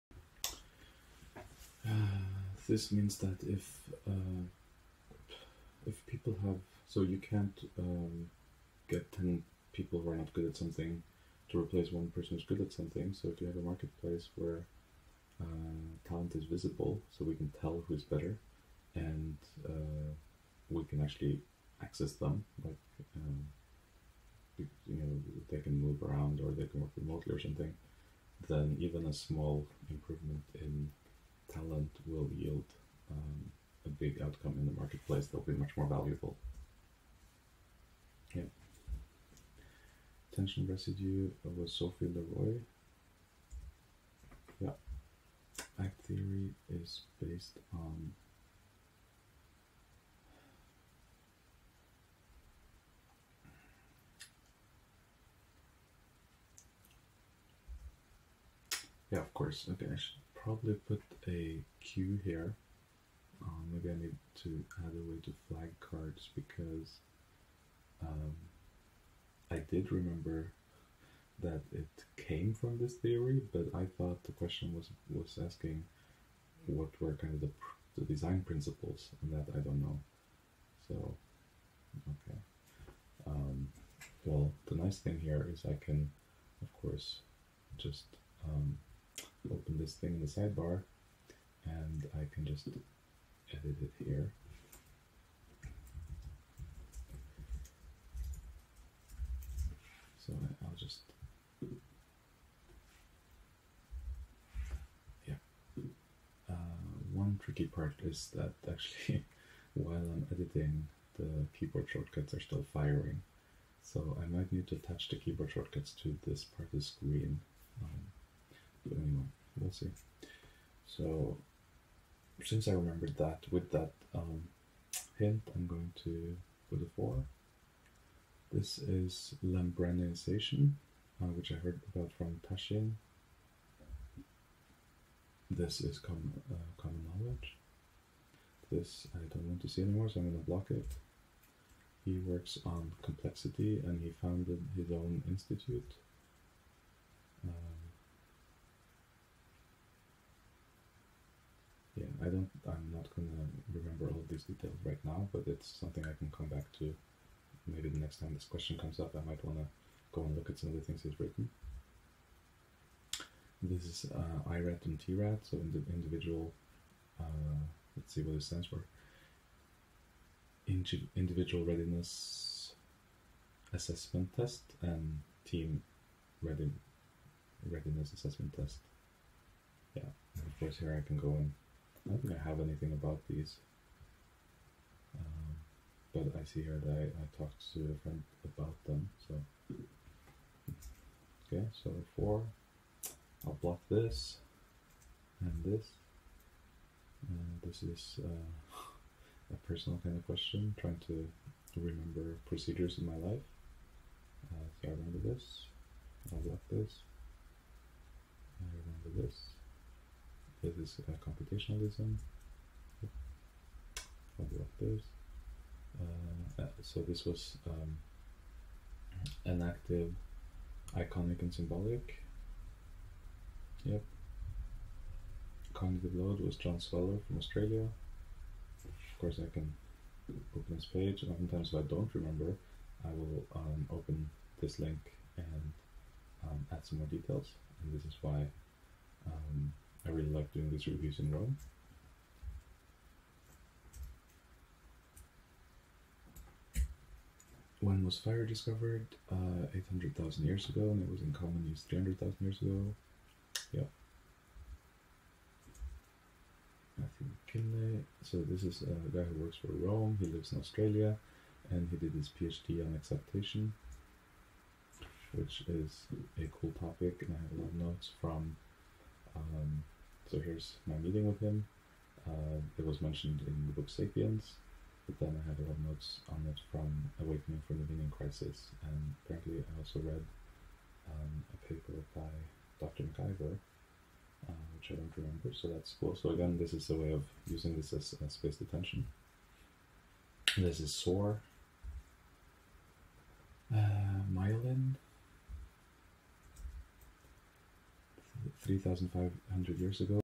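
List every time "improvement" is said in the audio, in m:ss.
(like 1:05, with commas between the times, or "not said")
0:29.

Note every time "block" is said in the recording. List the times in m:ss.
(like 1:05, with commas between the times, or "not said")
2:20, 3:13, 3:26.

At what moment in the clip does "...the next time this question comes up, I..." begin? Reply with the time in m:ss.
2:37.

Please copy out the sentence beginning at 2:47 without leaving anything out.
Uh, let's see what it stands for.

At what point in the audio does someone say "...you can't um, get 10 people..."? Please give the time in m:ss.
0:07.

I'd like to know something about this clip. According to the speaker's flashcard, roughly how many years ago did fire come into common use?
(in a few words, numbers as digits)
300,000 years ago.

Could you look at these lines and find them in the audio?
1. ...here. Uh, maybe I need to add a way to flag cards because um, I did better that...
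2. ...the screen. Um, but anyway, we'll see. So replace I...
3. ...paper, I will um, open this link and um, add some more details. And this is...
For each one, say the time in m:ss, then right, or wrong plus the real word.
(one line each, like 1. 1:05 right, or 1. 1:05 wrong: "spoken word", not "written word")
1. 1:02 wrong: "remember", not "better"
2. 1:56 wrong: "since", not "replace"
3. 3:52 wrong: "remember", not "paper".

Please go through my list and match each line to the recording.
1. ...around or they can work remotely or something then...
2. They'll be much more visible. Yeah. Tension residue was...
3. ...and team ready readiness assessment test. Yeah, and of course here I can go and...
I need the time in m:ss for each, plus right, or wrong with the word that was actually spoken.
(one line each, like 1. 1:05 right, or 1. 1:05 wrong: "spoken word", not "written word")
1. 0:26 right
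2. 0:35 wrong: "valuable", not "visible"
3. 2:54 right.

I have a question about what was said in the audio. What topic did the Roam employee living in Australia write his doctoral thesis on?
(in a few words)
exaptation.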